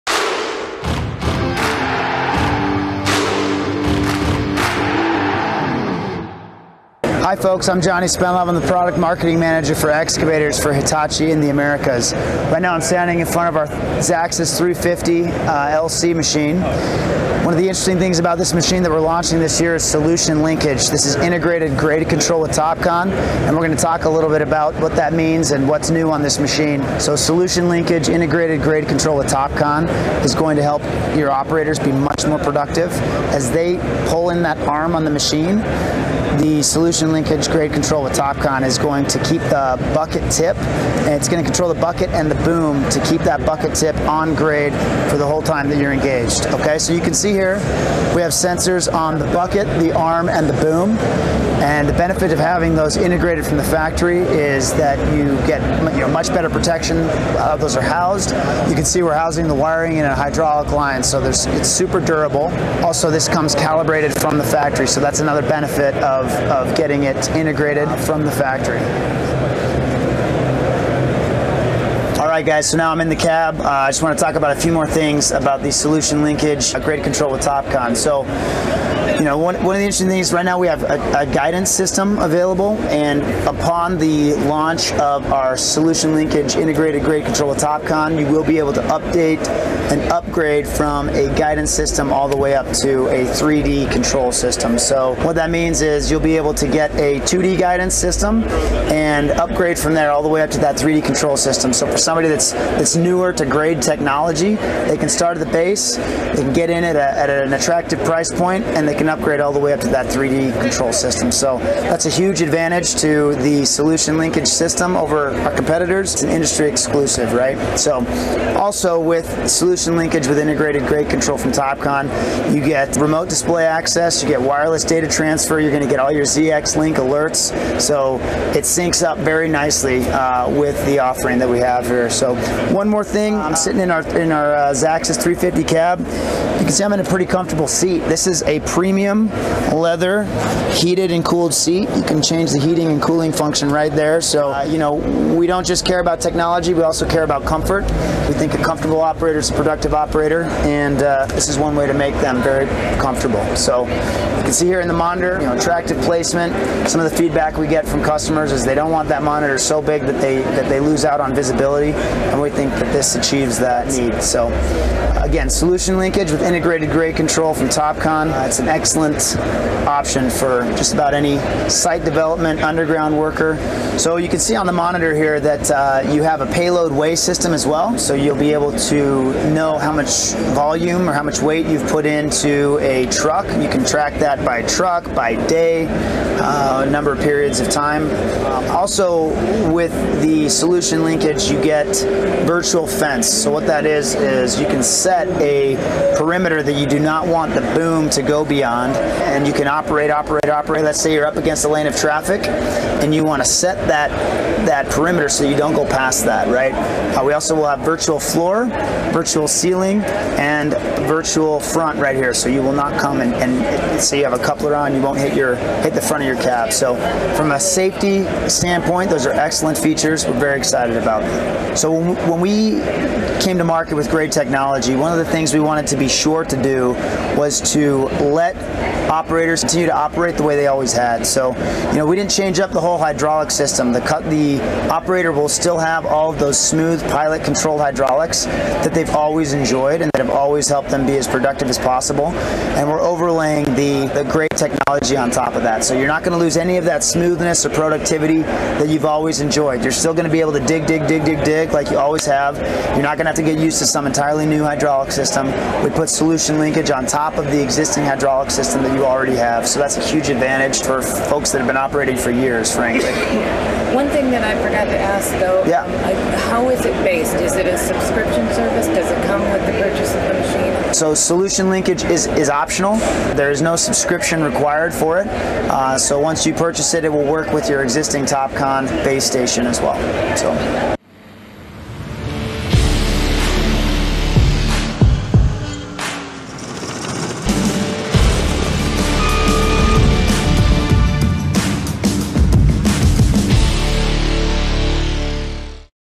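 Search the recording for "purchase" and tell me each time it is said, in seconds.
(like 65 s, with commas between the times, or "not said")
269 s, 276 s.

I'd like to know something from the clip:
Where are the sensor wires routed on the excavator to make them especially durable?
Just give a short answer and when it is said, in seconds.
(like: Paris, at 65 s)
In a hydraulic line, at 59 s.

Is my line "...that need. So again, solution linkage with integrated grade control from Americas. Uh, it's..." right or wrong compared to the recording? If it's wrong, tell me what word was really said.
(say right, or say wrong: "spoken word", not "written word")
wrong: "Topcon", not "Americas".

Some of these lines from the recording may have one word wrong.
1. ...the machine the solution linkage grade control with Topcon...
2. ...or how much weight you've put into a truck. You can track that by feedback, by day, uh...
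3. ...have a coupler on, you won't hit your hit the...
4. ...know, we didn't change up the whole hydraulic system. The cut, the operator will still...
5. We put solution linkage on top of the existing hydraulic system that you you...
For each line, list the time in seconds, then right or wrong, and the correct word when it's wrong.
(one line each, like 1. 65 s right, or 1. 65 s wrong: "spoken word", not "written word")
1. 35 s right
2. 181 s wrong: "truck", not "feedback"
3. 214 s right
4. 231 s right
5. 255 s right.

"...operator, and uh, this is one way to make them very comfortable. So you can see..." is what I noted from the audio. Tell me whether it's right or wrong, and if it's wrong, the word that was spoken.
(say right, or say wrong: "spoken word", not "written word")
right.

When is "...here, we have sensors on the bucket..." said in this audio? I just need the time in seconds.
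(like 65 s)
47 s.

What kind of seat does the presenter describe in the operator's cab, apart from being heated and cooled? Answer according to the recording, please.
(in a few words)
Premium leather.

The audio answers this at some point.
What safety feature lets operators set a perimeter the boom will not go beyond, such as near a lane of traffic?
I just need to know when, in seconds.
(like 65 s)
192 s.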